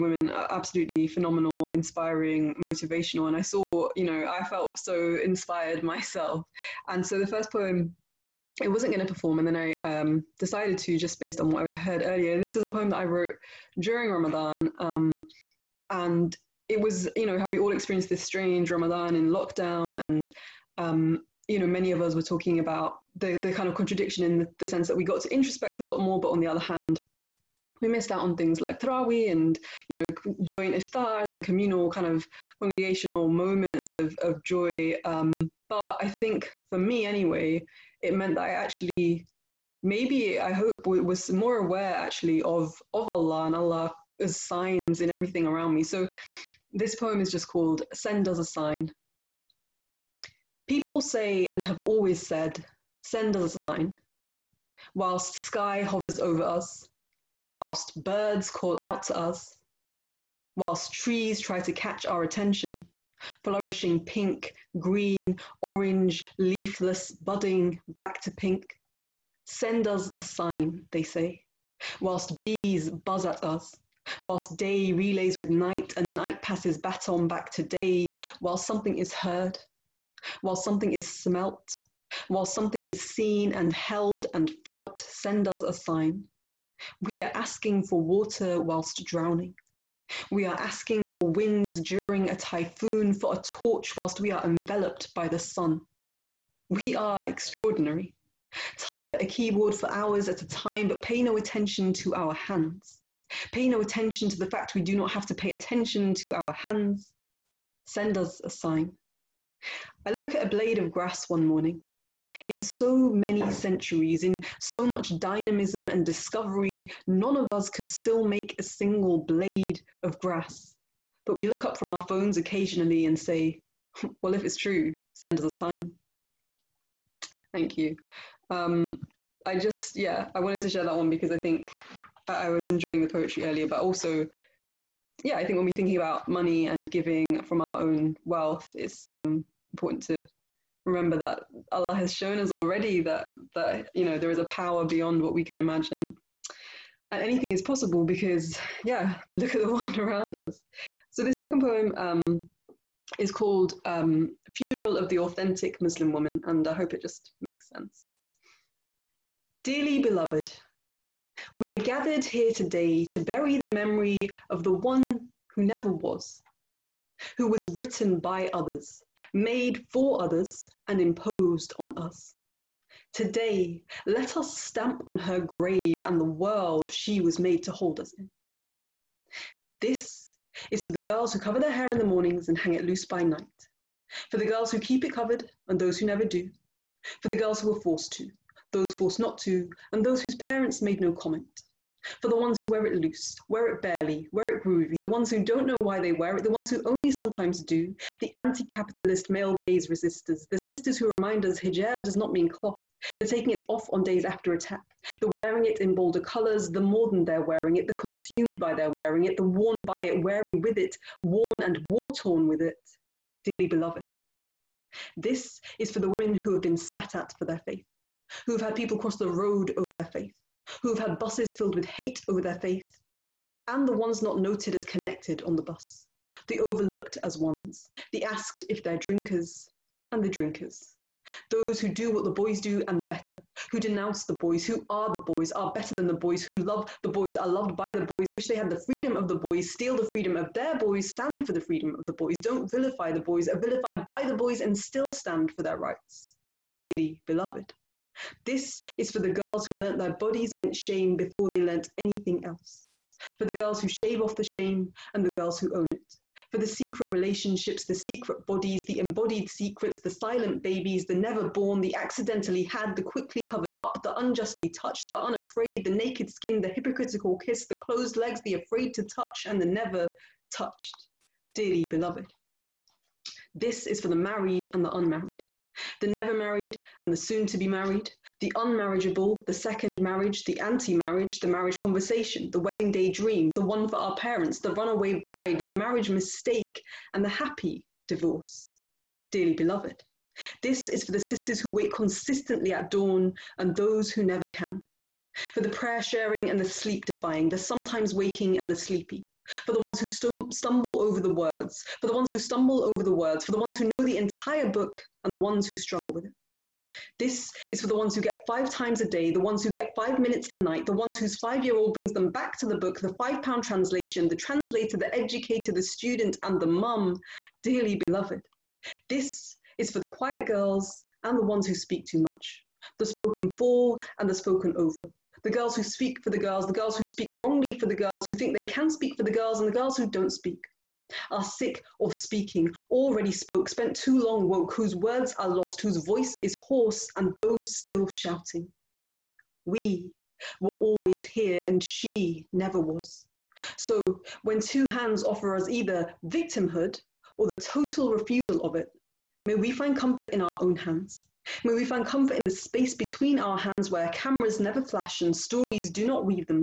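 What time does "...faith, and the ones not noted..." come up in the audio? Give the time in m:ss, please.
3:42.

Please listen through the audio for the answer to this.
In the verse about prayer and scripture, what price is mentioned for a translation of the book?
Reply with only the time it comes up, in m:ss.
5:13.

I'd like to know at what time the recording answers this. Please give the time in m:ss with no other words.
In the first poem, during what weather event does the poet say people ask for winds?
1:32.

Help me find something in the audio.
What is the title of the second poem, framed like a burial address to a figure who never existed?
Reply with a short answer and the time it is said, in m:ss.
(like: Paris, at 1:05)
Funeral of the Authentic Muslim Woman, at 2:34.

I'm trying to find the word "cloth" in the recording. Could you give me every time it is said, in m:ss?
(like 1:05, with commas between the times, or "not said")
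3:22.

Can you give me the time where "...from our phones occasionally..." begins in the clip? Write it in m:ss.
2:01.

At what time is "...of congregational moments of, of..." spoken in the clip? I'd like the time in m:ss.
0:32.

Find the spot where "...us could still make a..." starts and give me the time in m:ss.
1:57.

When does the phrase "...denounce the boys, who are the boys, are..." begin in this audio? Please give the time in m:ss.
3:53.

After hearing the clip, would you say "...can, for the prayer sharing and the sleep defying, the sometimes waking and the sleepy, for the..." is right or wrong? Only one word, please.
right.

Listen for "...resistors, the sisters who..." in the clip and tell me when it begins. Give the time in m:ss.
3:19.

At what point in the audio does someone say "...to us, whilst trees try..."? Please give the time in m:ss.
0:59.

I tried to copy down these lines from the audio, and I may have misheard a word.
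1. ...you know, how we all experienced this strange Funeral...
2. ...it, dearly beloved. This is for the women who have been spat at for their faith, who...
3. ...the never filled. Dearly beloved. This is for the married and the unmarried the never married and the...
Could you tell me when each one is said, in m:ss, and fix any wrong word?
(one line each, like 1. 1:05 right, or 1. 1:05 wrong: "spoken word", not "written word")
1. 0:17 wrong: "Ramadan", not "Funeral"
2. 3:32 right
3. 4:29 wrong: "touched", not "filled".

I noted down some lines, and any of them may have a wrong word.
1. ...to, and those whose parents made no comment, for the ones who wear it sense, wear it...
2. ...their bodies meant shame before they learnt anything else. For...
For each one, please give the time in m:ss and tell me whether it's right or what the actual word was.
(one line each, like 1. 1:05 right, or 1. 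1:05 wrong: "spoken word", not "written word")
1. 3:09 wrong: "loose", not "sense"
2. 4:09 right.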